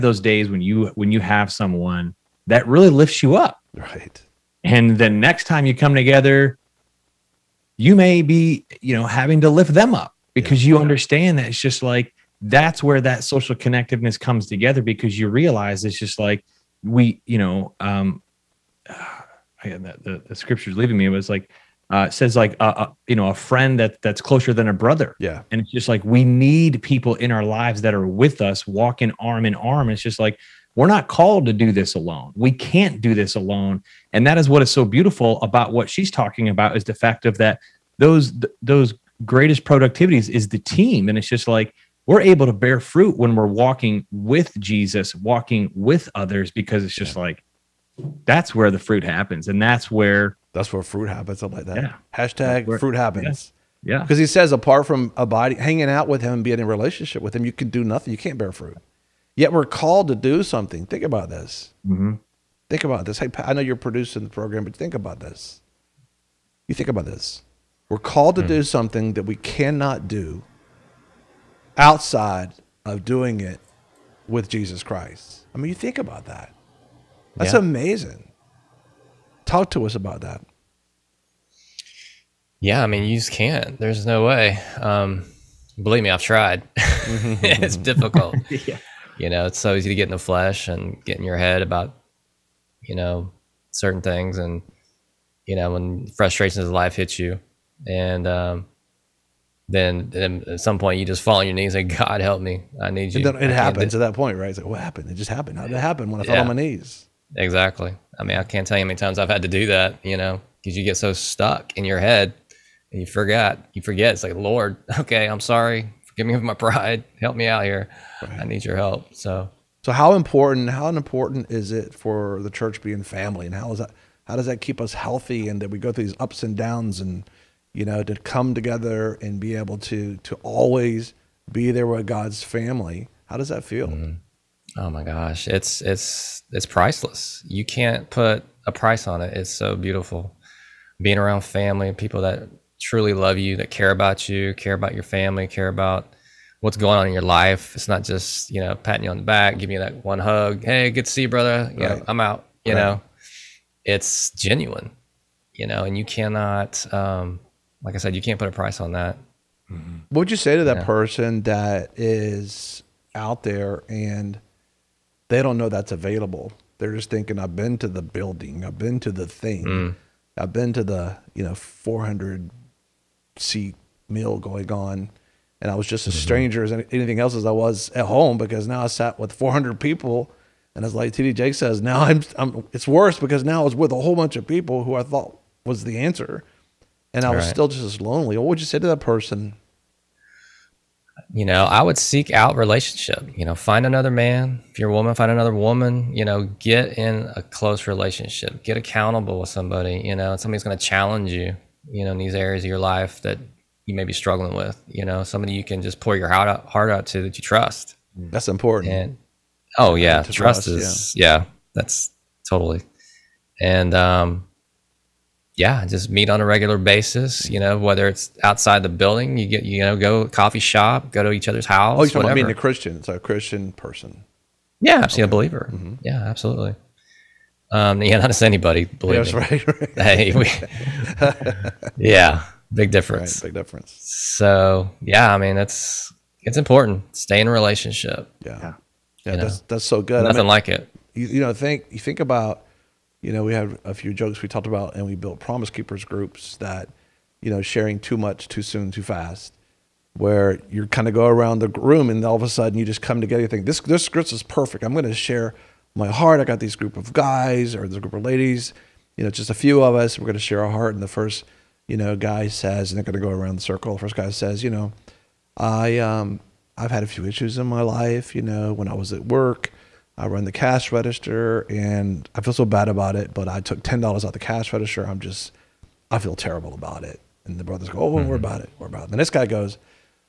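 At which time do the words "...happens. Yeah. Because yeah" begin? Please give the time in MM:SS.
00:52.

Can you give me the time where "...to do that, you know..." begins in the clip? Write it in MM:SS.
01:49.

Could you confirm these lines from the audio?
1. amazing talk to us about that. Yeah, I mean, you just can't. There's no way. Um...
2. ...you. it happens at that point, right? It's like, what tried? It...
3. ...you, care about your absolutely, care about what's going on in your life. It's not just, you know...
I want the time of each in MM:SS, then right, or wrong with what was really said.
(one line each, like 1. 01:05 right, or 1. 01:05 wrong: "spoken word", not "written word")
1. 01:17 right
2. 01:43 wrong: "happened", not "tried"
3. 02:24 wrong: "family", not "absolutely".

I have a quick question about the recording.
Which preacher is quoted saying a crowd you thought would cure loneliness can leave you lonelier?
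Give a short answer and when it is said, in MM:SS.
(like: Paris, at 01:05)
TD Jakes, at 03:01.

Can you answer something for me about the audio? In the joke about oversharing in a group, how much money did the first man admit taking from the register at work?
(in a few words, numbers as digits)
$10.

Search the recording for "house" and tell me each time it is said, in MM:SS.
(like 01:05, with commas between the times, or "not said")
03:41.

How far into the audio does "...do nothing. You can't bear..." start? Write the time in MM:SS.
00:57.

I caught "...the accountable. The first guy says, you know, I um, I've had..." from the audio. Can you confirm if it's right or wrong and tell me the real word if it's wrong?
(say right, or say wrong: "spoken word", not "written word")
wrong: "circle", not "accountable".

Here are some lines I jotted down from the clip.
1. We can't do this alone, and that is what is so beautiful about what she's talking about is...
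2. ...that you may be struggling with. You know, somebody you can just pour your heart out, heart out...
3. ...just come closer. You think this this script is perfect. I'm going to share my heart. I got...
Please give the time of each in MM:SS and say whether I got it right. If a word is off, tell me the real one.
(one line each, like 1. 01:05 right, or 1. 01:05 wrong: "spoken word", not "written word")
1. 00:32 right
2. 03:23 right
3. 04:12 wrong: "together", not "closer".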